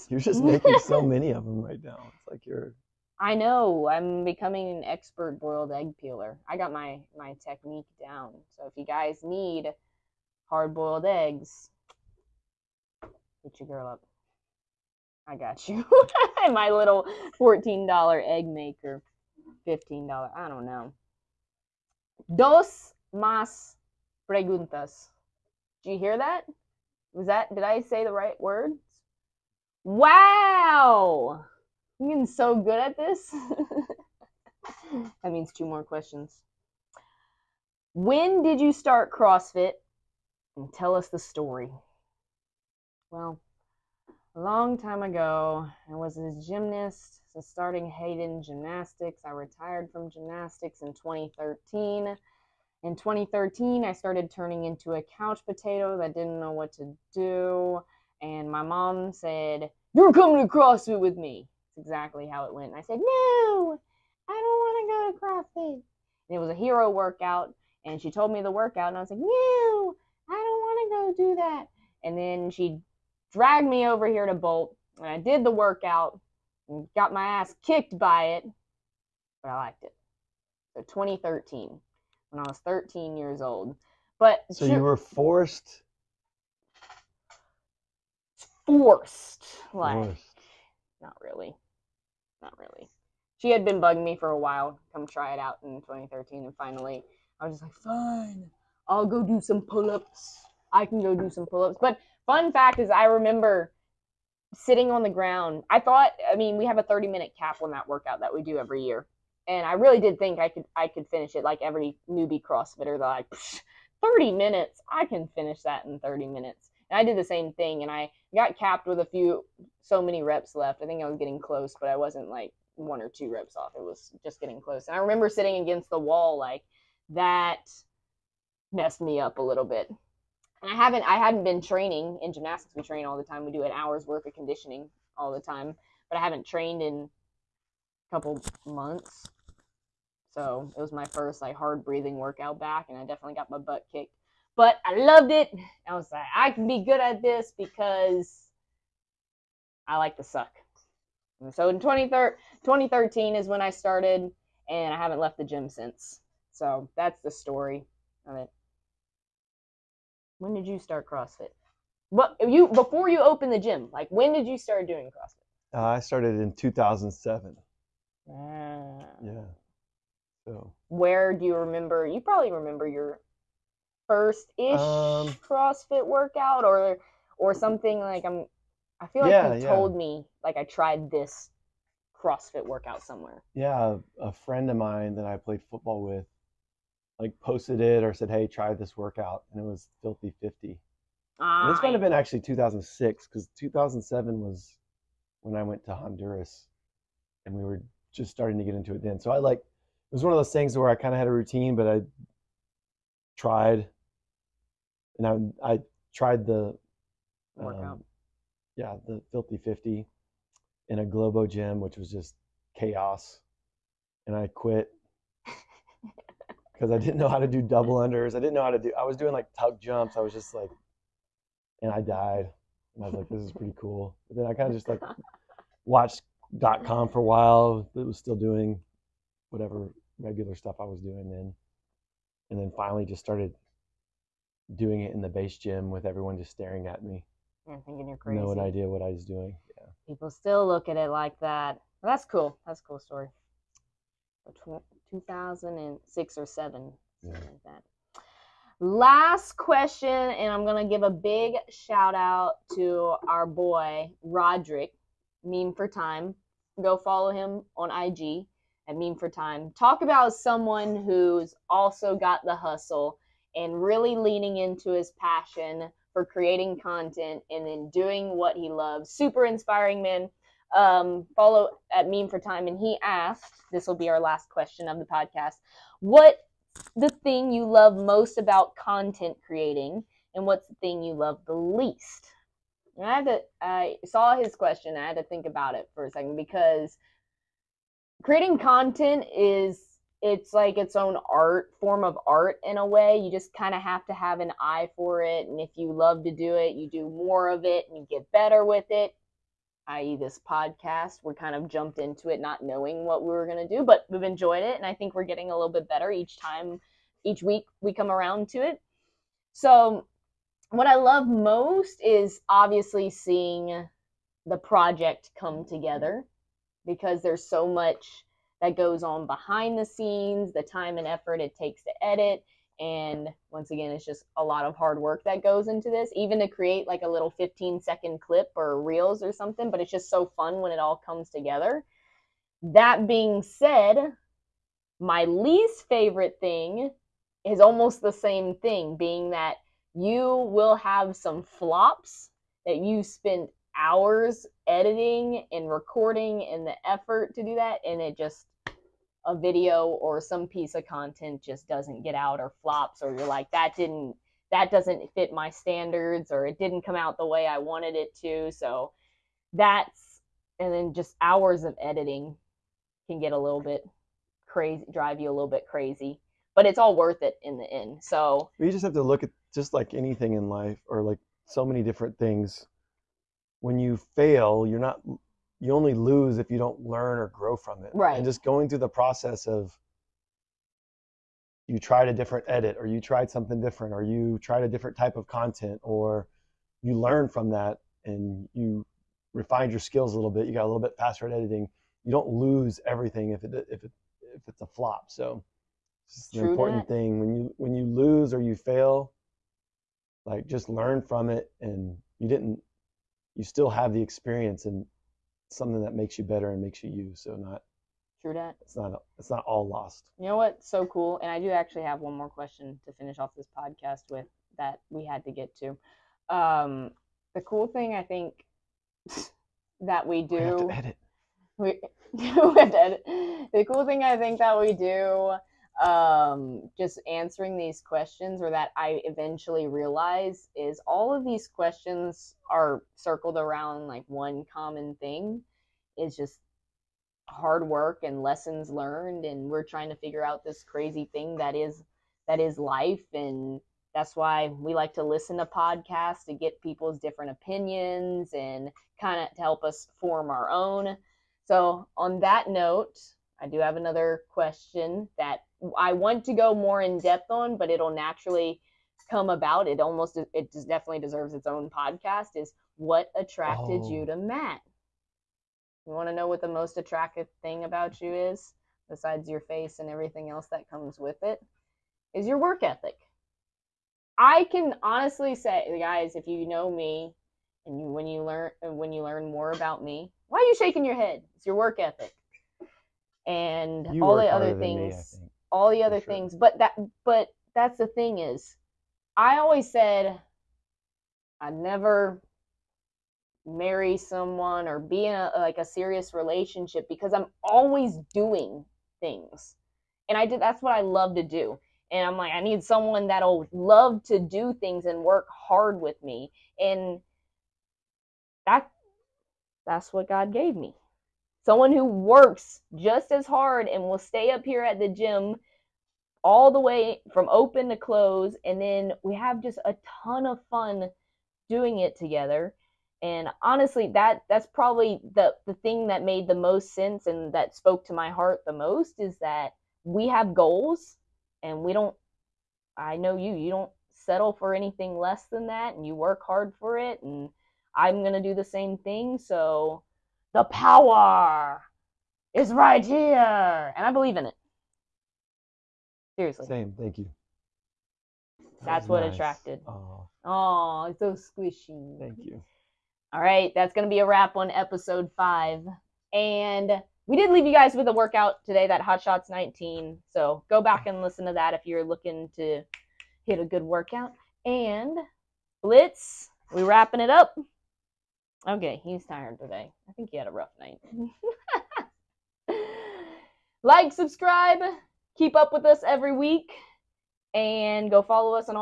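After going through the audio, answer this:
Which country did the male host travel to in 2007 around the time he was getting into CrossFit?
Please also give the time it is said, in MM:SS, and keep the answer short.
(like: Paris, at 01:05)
Honduras, at 03:15.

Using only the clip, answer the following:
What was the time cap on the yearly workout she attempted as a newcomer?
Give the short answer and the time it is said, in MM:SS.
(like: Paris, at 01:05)
30 minutes, at 01:46.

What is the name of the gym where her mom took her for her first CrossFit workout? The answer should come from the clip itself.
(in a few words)
Bolt.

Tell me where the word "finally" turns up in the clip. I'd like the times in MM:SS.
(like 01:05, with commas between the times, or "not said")
01:36, 03:52.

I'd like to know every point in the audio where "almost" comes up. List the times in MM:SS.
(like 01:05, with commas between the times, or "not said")
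05:37, 07:39.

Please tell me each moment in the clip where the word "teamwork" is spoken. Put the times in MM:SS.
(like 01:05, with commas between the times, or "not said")
not said.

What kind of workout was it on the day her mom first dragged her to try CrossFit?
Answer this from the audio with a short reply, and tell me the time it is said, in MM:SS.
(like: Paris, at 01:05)
hero workout, at 01:06.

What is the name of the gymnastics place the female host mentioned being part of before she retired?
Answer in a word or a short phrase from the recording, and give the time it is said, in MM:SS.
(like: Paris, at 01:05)
Hayden Gymnastics, at 00:47.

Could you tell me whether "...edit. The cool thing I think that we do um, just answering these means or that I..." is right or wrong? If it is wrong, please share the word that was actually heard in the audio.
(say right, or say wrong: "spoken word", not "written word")
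wrong: "questions", not "means".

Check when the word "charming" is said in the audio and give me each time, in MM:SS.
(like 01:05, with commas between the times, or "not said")
not said.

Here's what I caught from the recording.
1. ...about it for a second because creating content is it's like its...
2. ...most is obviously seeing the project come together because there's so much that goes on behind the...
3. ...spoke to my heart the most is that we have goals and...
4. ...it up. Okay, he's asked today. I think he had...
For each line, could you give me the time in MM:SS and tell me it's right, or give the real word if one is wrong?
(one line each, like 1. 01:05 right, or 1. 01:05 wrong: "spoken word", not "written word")
1. 04:45 right
2. 05:11 right
3. 08:47 right
4. 09:27 wrong: "tired", not "asked".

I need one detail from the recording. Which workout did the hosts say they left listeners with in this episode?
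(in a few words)
Hot Shots 19.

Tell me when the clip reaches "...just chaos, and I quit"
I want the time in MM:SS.
03:32.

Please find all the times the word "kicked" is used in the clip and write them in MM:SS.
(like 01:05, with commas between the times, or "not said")
01:17, 02:23.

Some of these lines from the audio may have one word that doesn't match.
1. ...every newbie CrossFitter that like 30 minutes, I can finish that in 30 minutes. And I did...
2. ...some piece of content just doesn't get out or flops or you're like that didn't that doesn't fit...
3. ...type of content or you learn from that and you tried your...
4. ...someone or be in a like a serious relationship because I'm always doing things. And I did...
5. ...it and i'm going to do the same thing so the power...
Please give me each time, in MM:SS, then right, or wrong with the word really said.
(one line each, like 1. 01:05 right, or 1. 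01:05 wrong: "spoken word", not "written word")
1. 01:51 right
2. 05:50 right
3. 06:24 wrong: "refined", not "tried"
4. 08:13 right
5. 08:56 right.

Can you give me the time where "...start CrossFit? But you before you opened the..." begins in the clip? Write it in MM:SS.
02:40.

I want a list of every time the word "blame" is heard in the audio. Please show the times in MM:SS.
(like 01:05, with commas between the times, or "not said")
not said.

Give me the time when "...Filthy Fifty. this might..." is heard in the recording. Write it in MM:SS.
03:10.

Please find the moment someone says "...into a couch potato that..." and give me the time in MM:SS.
00:54.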